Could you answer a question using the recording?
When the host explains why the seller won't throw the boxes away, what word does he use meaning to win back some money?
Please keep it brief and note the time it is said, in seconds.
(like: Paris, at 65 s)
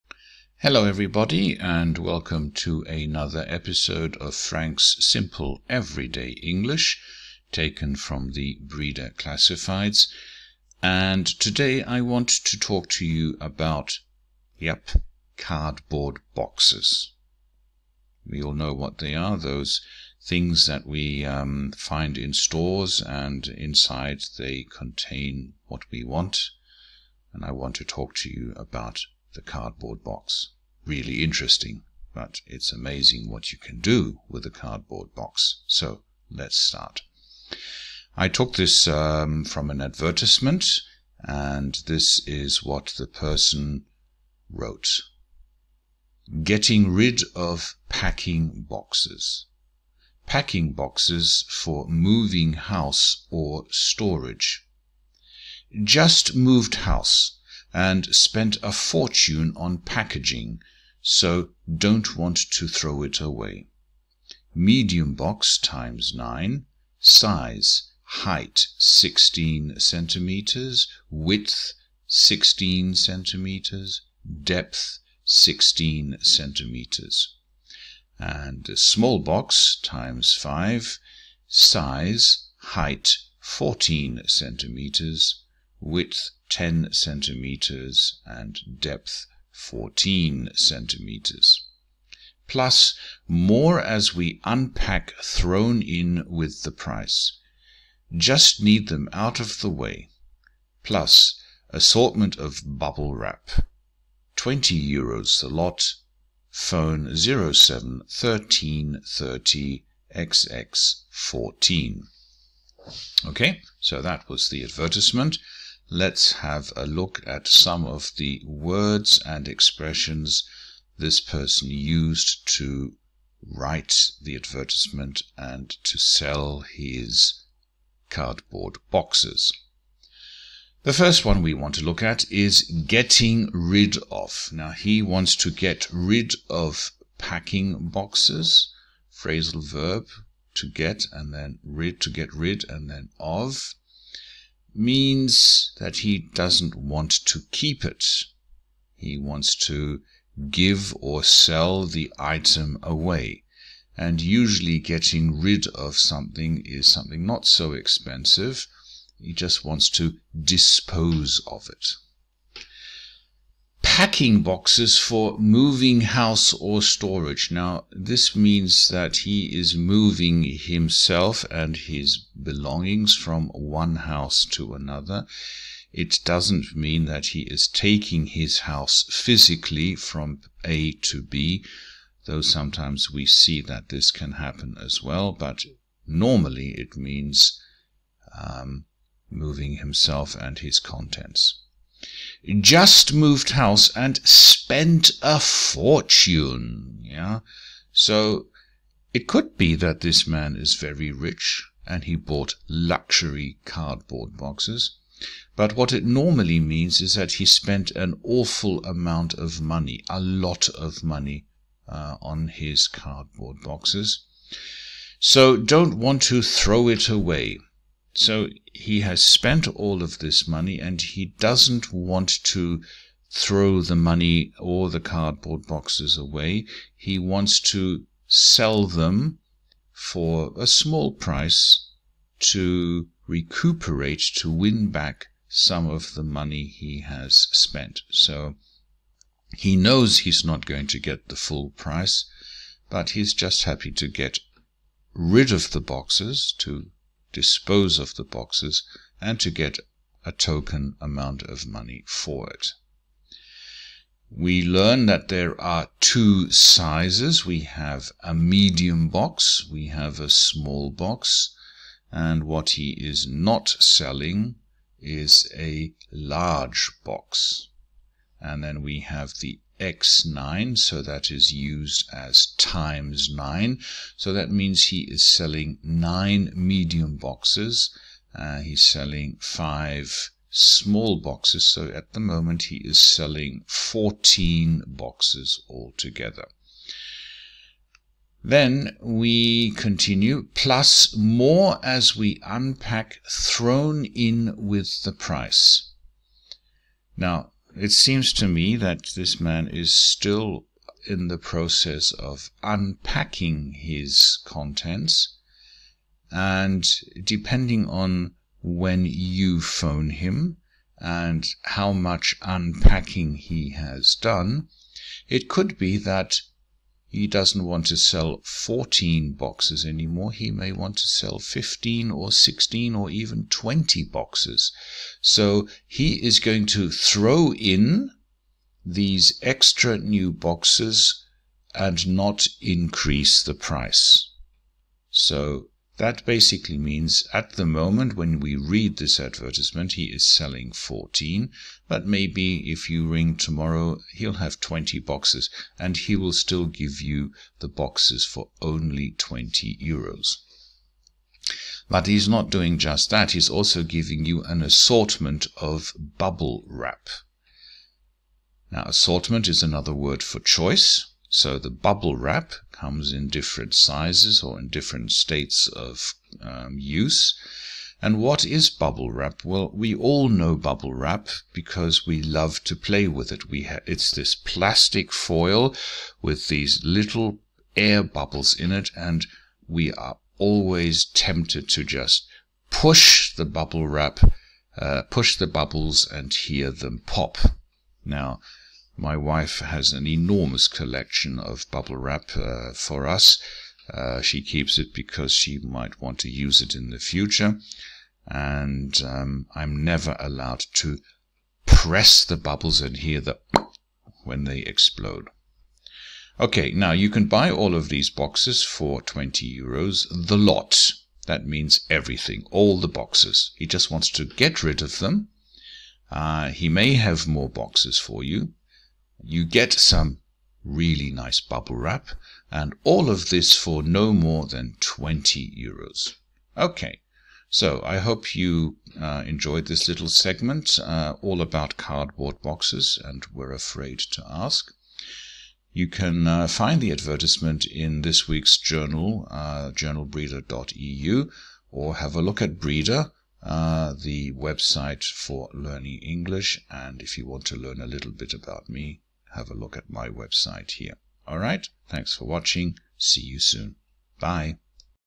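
recuperate, at 233 s.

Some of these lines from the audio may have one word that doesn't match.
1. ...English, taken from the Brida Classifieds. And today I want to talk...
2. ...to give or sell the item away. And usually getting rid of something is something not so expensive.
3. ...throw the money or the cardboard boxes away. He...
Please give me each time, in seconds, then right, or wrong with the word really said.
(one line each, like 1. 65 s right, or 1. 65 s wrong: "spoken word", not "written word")
1. 6 s right
2. 149 s right
3. 223 s right.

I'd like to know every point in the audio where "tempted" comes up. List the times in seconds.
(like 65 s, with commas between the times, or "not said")
381 s.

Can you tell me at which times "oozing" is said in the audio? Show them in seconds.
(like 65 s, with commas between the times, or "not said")
not said.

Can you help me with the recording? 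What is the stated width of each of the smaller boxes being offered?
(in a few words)
10 centimeters.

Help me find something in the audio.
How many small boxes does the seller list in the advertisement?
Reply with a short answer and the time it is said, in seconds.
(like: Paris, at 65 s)
5, at 78 s.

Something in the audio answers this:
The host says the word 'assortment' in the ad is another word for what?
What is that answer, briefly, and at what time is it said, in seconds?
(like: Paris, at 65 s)
choice, at 360 s.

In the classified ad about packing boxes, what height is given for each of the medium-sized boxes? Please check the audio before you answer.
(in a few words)
16 centimeters.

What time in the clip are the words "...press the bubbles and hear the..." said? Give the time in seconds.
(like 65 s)
401 s.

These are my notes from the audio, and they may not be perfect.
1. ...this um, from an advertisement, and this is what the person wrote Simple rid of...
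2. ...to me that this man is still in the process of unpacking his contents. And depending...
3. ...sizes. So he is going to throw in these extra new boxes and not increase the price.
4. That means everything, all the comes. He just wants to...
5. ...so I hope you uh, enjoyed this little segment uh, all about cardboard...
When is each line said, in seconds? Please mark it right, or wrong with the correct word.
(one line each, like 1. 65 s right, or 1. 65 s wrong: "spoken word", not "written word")
1. 38 s wrong: "Getting", not "Simple"
2. 298 s right
3. 324 s wrong: "boxes", not "sizes"
4. 411 s wrong: "boxes", not "comes"
5. 427 s right.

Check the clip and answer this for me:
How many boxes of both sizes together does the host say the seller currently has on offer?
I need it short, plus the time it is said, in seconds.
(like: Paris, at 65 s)
14, at 283 s.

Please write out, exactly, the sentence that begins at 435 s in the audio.
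You can uh, find the advertisement in this week's journal, uh, journalbrida.eu, or have a look at Brida.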